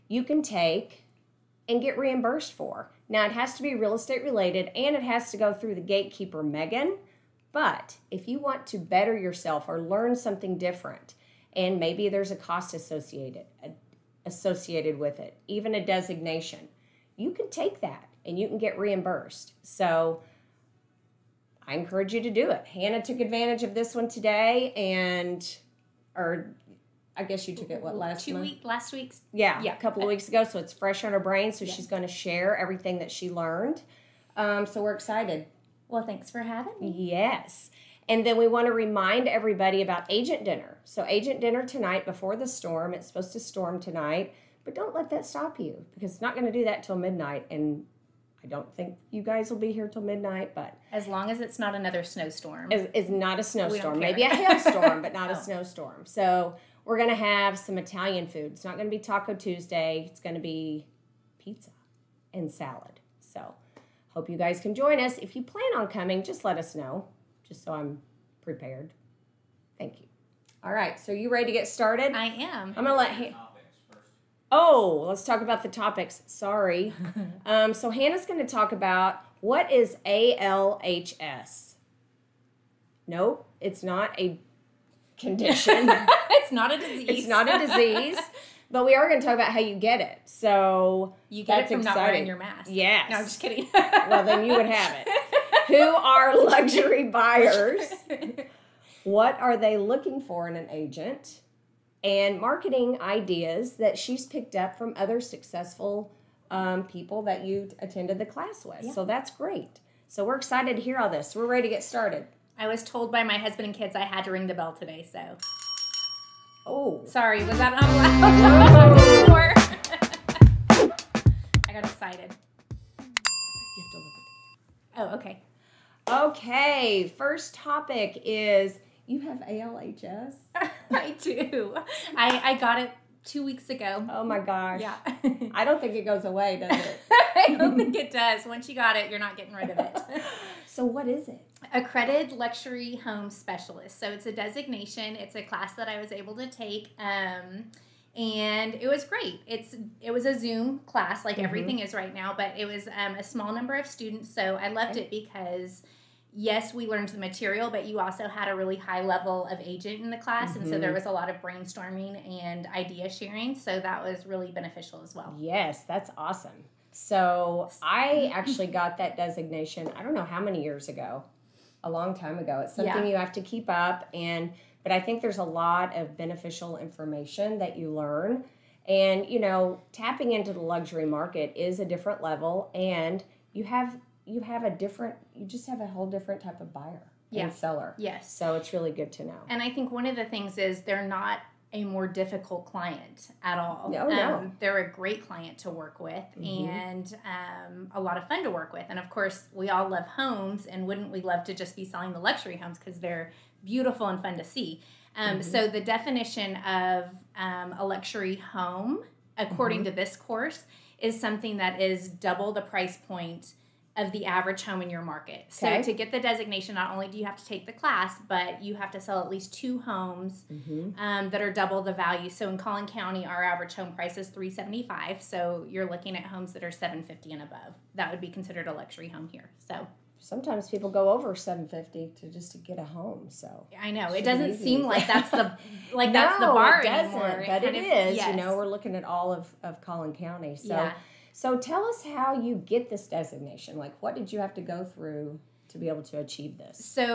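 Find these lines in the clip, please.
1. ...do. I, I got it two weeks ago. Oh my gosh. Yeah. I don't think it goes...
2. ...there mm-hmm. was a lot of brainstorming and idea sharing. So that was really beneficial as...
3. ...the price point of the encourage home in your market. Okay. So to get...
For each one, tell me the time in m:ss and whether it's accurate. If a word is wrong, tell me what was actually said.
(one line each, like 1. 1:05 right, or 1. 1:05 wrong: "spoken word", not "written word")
1. 2:11 right
2. 2:40 right
3. 3:32 wrong: "average", not "encourage".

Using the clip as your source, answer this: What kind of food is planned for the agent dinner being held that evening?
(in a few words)
Italian food.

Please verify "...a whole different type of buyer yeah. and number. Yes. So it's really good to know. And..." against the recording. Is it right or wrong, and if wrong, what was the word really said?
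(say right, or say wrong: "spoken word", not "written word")
wrong: "seller", not "number".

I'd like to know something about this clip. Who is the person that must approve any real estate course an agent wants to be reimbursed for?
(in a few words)
Megan.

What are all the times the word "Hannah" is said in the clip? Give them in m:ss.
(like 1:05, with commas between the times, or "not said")
0:22, 1:17.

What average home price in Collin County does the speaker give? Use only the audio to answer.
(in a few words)
375.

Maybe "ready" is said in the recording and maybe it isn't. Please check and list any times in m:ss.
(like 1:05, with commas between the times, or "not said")
1:11, 1:51.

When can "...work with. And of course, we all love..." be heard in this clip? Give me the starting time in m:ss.
3:18.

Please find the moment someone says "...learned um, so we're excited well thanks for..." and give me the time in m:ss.
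0:33.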